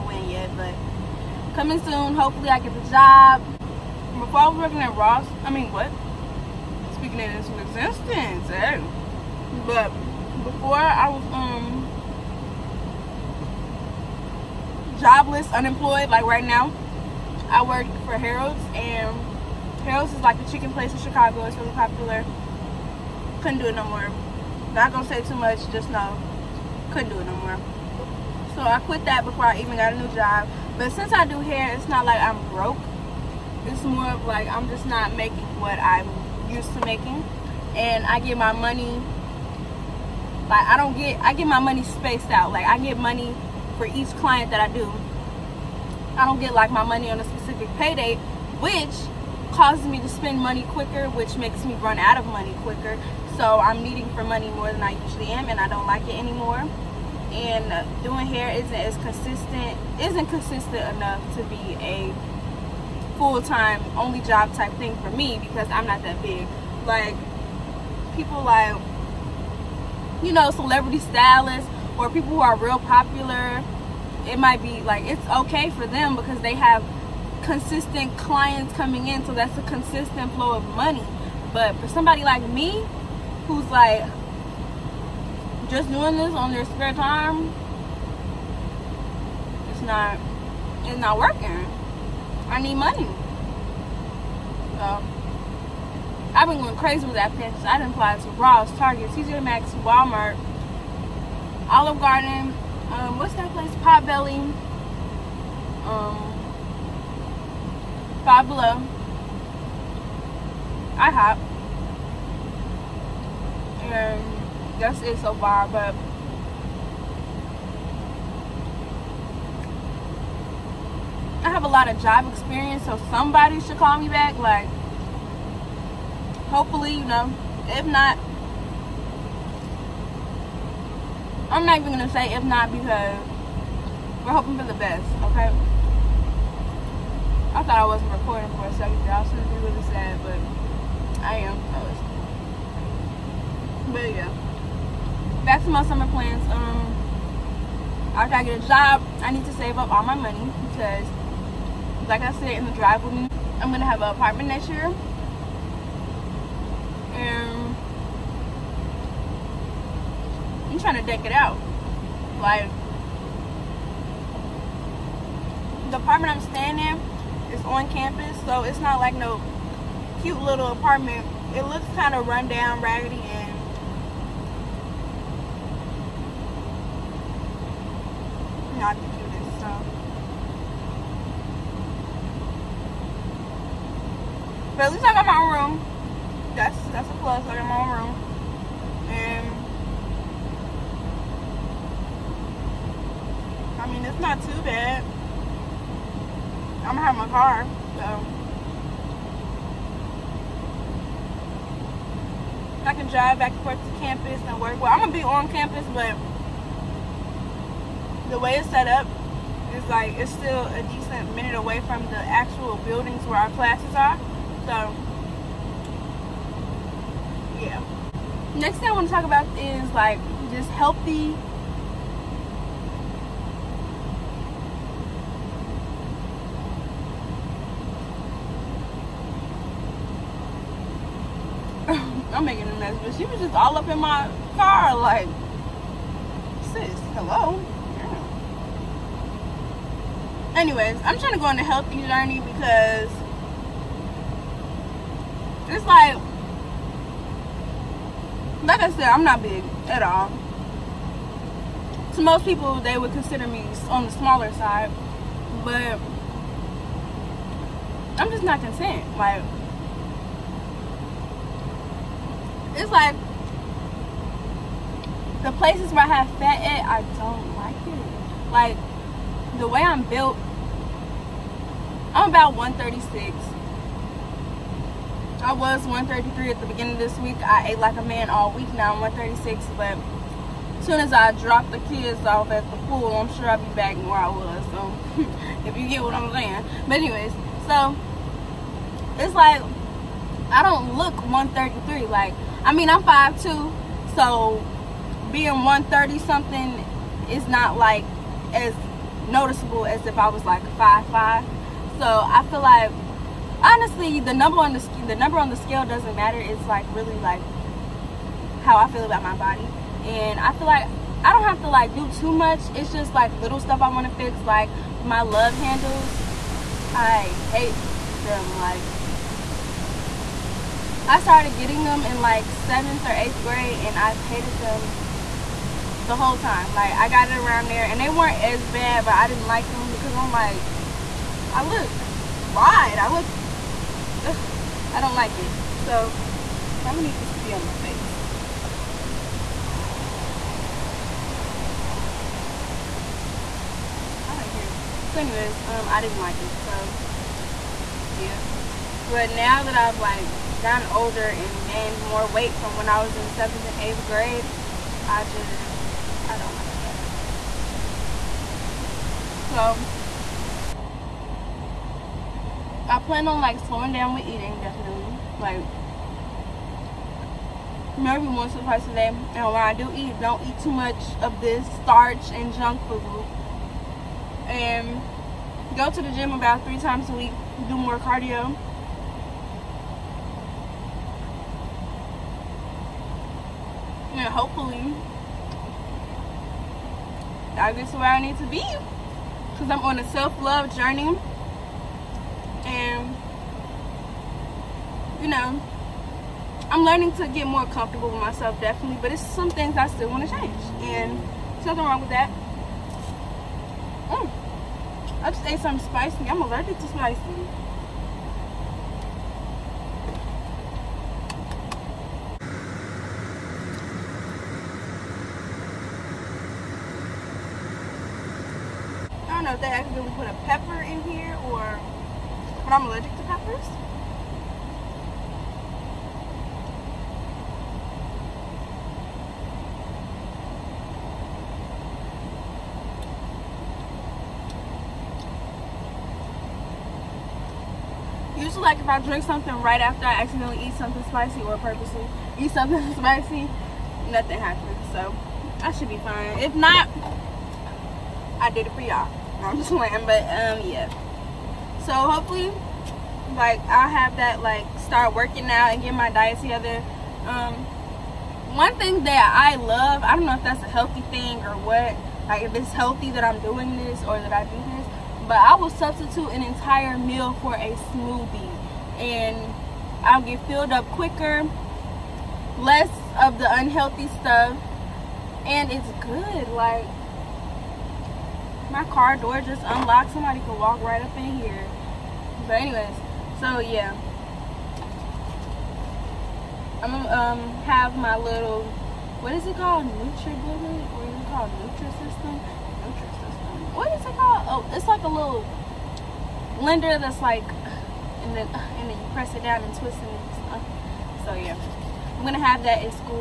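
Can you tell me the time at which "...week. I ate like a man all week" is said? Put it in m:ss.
4:37.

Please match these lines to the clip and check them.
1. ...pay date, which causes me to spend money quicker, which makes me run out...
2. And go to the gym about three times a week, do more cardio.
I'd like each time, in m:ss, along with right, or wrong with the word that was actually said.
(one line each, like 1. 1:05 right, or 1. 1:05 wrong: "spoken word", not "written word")
1. 0:47 right
2. 6:14 right.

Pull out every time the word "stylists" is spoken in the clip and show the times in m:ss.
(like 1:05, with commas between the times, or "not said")
1:10.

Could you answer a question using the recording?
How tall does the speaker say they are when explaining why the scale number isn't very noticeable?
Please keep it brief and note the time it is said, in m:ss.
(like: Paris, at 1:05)
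5'2", at 4:53.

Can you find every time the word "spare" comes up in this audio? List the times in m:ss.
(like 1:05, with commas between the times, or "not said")
1:26.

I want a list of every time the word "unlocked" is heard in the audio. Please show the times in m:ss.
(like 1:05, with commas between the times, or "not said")
7:59.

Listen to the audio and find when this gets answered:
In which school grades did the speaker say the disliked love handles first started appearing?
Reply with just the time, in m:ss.
5:22.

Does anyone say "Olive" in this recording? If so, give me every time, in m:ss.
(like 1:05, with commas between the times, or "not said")
1:41.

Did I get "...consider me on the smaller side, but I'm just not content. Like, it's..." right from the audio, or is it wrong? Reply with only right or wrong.
right.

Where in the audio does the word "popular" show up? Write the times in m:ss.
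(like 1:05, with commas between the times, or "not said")
0:21, 1:12.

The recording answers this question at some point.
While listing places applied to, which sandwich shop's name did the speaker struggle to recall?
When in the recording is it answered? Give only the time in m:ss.
1:43.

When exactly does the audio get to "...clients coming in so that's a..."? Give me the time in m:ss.
1:18.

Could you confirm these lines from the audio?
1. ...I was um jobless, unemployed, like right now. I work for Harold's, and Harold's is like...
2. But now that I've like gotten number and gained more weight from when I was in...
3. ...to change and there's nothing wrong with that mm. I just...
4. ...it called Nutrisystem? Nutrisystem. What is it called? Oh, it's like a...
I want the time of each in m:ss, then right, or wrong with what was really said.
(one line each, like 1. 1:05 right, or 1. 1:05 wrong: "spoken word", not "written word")
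1. 0:10 right
2. 5:49 wrong: "older", not "number"
3. 6:40 right
4. 8:11 right.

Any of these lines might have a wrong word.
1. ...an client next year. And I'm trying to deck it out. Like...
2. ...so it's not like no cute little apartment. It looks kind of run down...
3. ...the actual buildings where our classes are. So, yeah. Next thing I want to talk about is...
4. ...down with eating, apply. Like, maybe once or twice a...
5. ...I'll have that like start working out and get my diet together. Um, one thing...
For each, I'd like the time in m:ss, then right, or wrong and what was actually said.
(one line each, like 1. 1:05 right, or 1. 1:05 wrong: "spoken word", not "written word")
1. 2:34 wrong: "apartment", not "client"
2. 2:48 right
3. 3:32 right
4. 6:03 wrong: "definitely", not "apply"
5. 7:33 right.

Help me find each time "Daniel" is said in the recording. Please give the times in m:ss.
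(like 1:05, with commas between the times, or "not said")
not said.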